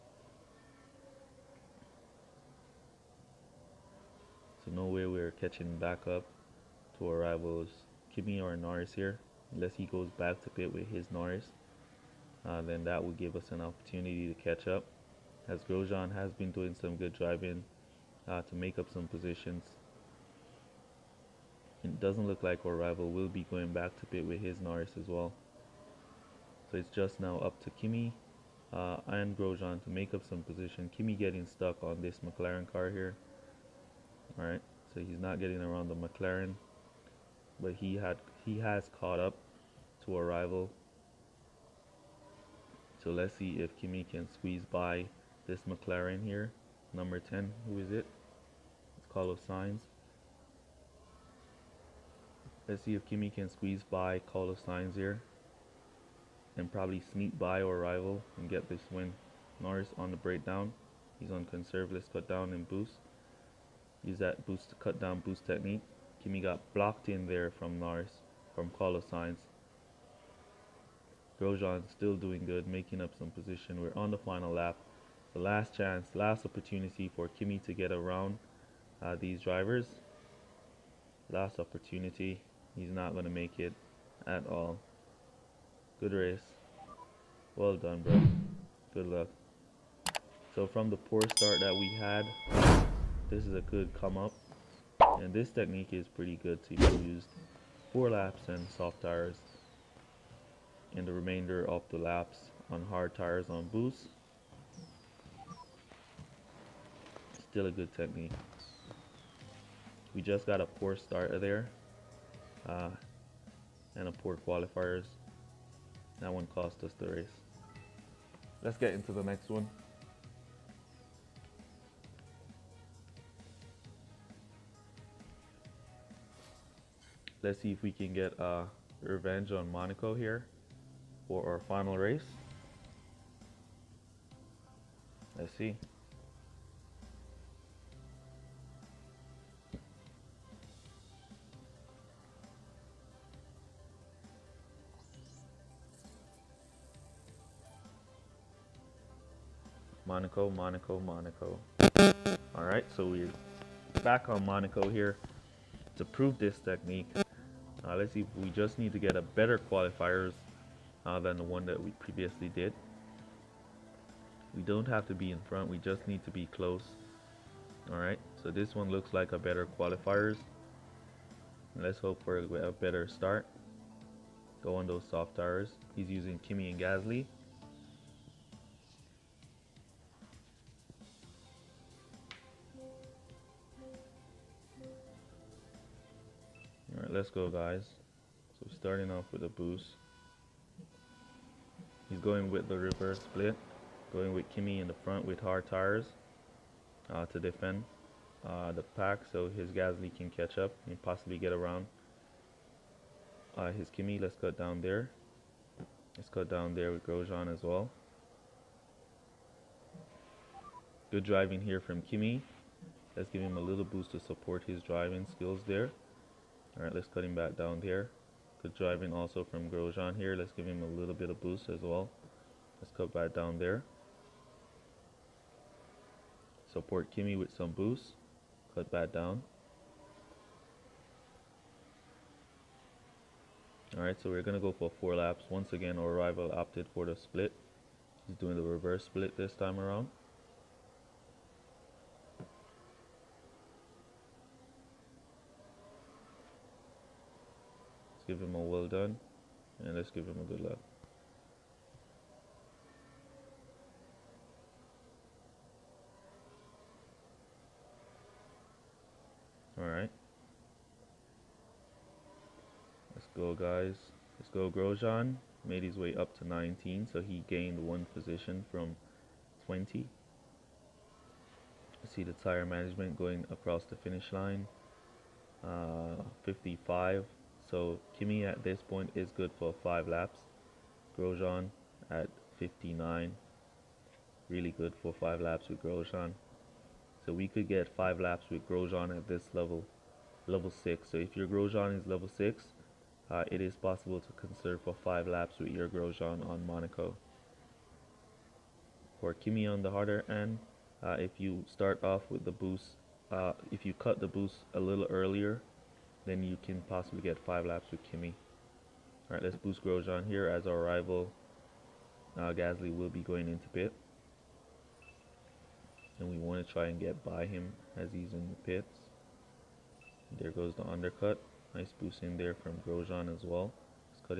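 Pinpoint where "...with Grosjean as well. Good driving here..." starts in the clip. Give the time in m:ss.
3:26.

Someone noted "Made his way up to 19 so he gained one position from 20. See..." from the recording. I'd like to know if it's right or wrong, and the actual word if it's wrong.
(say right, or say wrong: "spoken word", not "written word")
right.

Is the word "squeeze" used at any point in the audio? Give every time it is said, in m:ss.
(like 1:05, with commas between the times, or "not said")
0:44, 0:53.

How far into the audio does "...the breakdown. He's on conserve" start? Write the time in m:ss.
1:00.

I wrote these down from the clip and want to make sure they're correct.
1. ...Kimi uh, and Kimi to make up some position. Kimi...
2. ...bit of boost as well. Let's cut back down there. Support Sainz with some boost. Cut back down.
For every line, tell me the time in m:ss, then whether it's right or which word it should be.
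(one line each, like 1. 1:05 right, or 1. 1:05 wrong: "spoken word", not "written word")
1. 0:27 wrong: "Grosjean", not "Kimi"
2. 3:41 wrong: "Kimi", not "Sainz".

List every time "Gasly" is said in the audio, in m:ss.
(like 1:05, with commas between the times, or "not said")
2:56, 3:19, 5:12.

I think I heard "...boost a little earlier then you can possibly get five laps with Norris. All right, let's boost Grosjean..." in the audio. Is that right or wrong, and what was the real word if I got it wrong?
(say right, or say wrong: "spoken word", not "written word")
wrong: "Kimi", not "Norris".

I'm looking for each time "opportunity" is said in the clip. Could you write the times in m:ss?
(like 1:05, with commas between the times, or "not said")
0:13, 1:16, 1:21.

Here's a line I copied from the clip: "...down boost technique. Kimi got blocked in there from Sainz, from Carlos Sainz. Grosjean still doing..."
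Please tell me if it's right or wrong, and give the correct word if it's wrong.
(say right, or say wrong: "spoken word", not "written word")
wrong: "Lars", not "Sainz".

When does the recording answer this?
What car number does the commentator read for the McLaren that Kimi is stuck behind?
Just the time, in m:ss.
0:46.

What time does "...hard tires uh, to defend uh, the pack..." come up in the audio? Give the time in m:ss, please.
3:15.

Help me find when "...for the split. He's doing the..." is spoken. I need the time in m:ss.
3:56.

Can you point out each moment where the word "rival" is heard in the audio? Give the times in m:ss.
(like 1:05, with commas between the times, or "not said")
0:07, 0:22, 0:40, 0:57, 3:56, 5:10.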